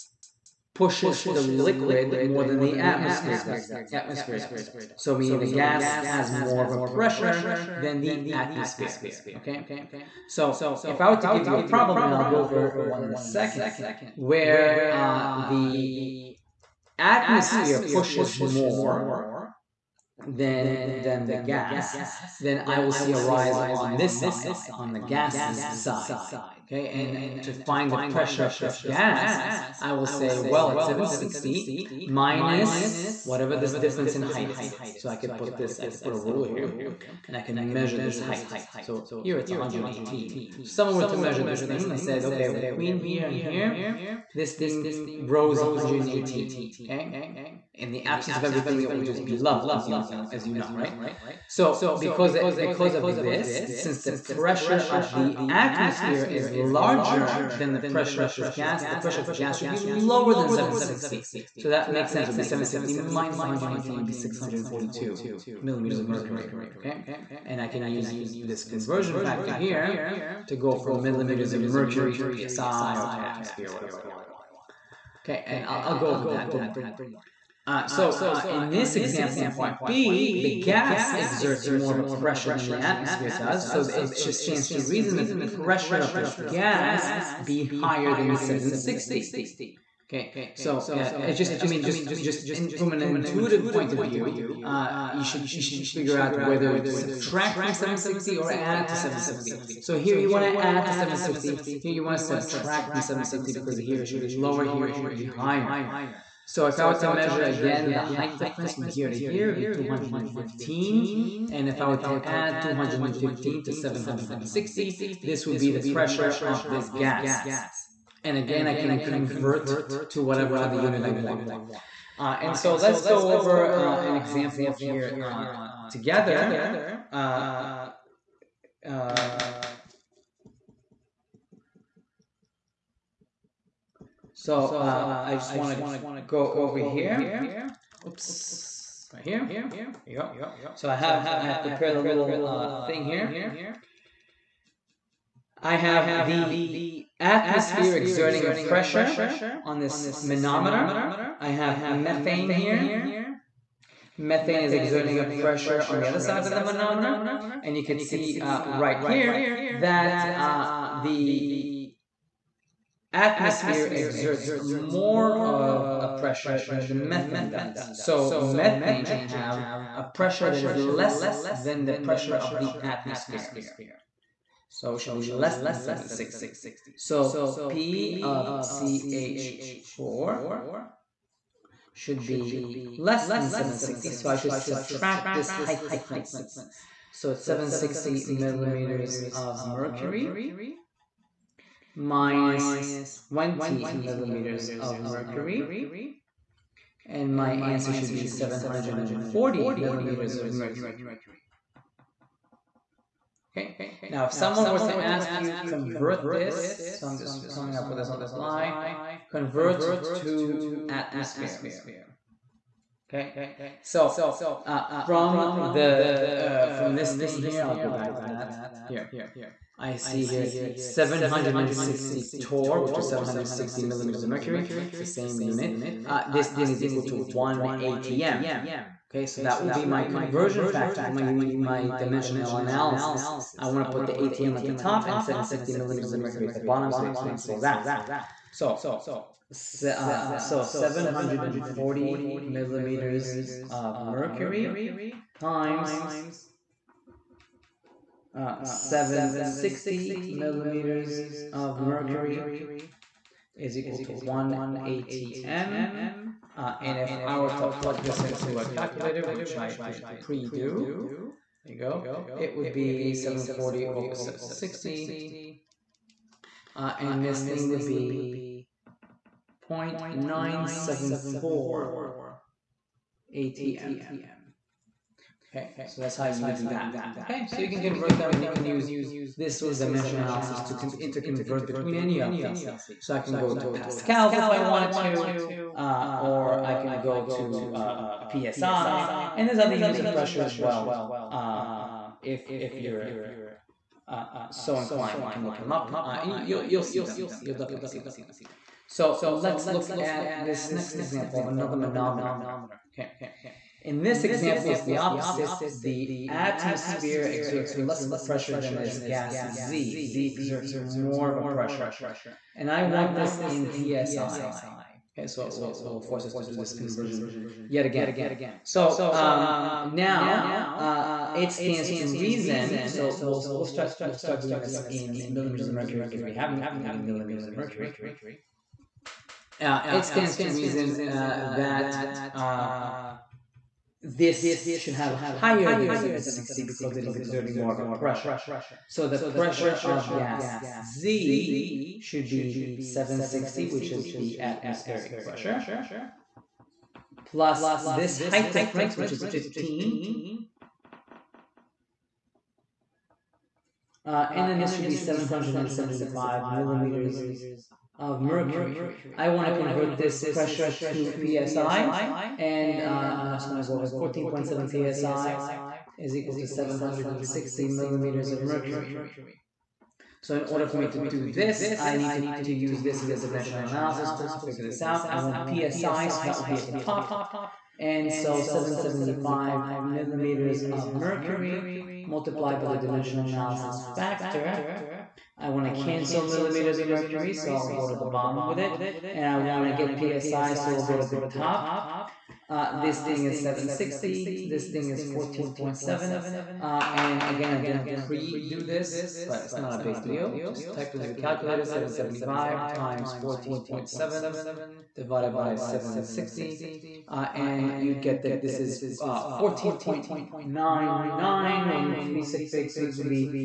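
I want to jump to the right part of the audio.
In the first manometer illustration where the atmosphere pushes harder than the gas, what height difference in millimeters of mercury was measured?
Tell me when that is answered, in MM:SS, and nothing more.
00:38.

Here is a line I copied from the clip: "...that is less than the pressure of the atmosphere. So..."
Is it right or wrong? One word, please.
right.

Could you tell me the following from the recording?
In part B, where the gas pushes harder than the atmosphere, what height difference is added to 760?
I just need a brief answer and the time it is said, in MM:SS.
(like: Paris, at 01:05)
215, at 01:49.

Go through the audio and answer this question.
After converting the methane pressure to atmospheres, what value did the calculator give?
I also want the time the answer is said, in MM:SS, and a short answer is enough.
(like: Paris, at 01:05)
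0.974 atm, at 04:29.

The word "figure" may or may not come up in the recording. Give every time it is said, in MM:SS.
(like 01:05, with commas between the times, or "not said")
01:35, 06:14.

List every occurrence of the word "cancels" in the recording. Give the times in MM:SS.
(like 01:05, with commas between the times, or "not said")
03:57, 06:25.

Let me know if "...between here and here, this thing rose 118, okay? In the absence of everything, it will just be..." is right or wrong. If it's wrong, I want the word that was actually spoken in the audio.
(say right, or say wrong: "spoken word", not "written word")
right.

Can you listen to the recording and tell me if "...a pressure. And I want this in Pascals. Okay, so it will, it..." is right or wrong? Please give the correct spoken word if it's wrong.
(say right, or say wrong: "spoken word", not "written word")
wrong: "PSI", not "Pascals".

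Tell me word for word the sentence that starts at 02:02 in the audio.
Uh, and so let's go over uh, an example here uh, together.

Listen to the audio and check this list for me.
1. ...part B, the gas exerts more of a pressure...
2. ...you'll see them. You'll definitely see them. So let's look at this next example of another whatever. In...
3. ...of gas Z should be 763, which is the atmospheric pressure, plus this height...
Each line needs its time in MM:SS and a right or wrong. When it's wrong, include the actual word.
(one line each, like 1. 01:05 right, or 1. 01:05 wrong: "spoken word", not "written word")
1. 01:19 right
2. 04:56 wrong: "manometer", not "whatever"
3. 05:39 wrong: "760", not "763".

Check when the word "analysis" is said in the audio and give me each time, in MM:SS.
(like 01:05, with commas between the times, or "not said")
03:52, 04:40, 06:13, 06:23.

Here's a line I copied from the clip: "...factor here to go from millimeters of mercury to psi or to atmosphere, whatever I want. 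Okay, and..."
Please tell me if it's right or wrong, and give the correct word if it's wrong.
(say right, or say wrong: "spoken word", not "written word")
right.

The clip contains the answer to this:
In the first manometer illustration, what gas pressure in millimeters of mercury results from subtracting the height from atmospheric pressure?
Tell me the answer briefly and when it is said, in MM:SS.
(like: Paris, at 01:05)
642, at 01:04.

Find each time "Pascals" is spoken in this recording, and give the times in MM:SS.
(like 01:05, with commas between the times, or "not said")
04:43.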